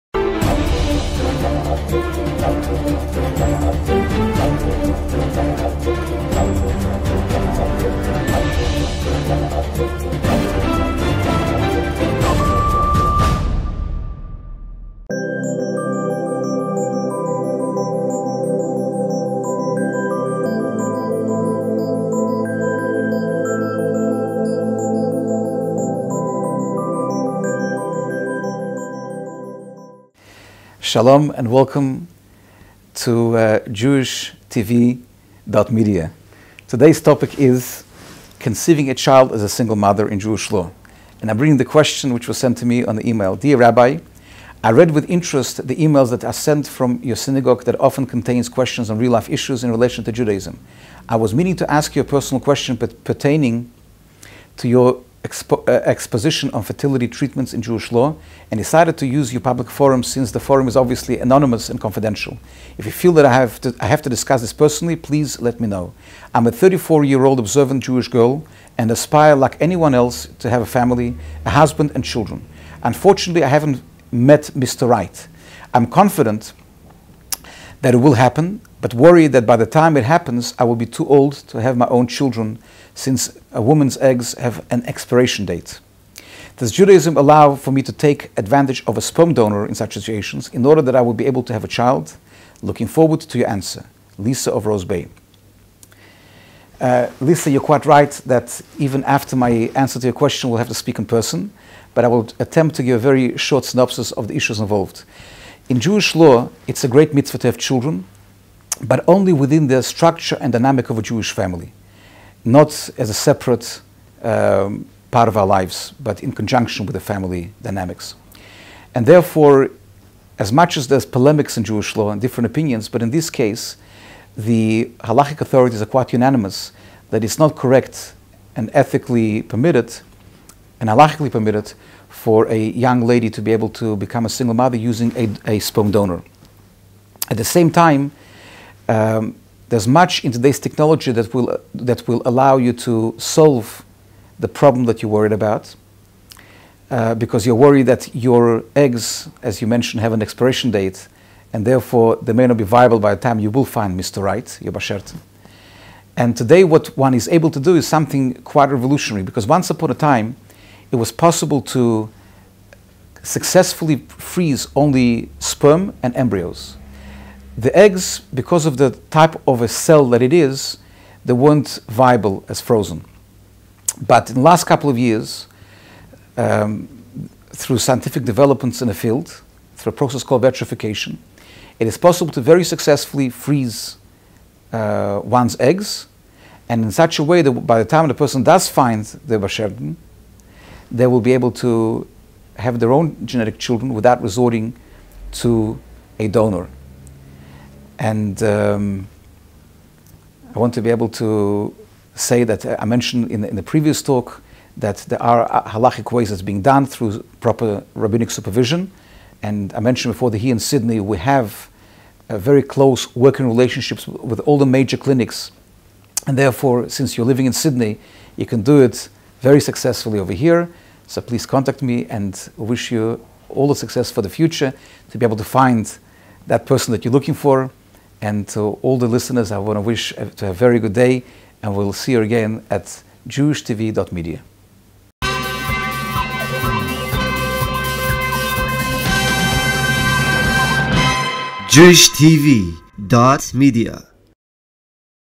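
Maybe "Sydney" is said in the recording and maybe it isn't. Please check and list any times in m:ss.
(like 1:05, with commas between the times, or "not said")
3:30, 3:37.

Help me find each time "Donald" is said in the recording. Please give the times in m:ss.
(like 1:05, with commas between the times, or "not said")
not said.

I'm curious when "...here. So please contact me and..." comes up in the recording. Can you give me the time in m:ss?
3:40.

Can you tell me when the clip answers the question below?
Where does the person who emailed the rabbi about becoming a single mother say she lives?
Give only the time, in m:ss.
1:34.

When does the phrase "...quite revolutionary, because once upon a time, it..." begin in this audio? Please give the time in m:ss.
2:38.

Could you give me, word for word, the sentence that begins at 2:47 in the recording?
The eggs, because of the type of a cell that it is, they weren't viable as frozen.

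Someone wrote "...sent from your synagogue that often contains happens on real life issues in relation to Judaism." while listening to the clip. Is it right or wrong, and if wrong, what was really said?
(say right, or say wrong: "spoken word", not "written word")
wrong: "questions", not "happens".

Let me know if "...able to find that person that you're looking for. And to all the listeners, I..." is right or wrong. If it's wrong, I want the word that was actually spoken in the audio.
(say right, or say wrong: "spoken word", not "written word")
right.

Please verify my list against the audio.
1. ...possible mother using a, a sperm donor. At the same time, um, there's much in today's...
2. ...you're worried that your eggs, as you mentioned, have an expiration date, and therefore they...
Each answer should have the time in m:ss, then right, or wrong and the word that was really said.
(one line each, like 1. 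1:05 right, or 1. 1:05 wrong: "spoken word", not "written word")
1. 2:14 wrong: "single", not "possible"
2. 2:27 right.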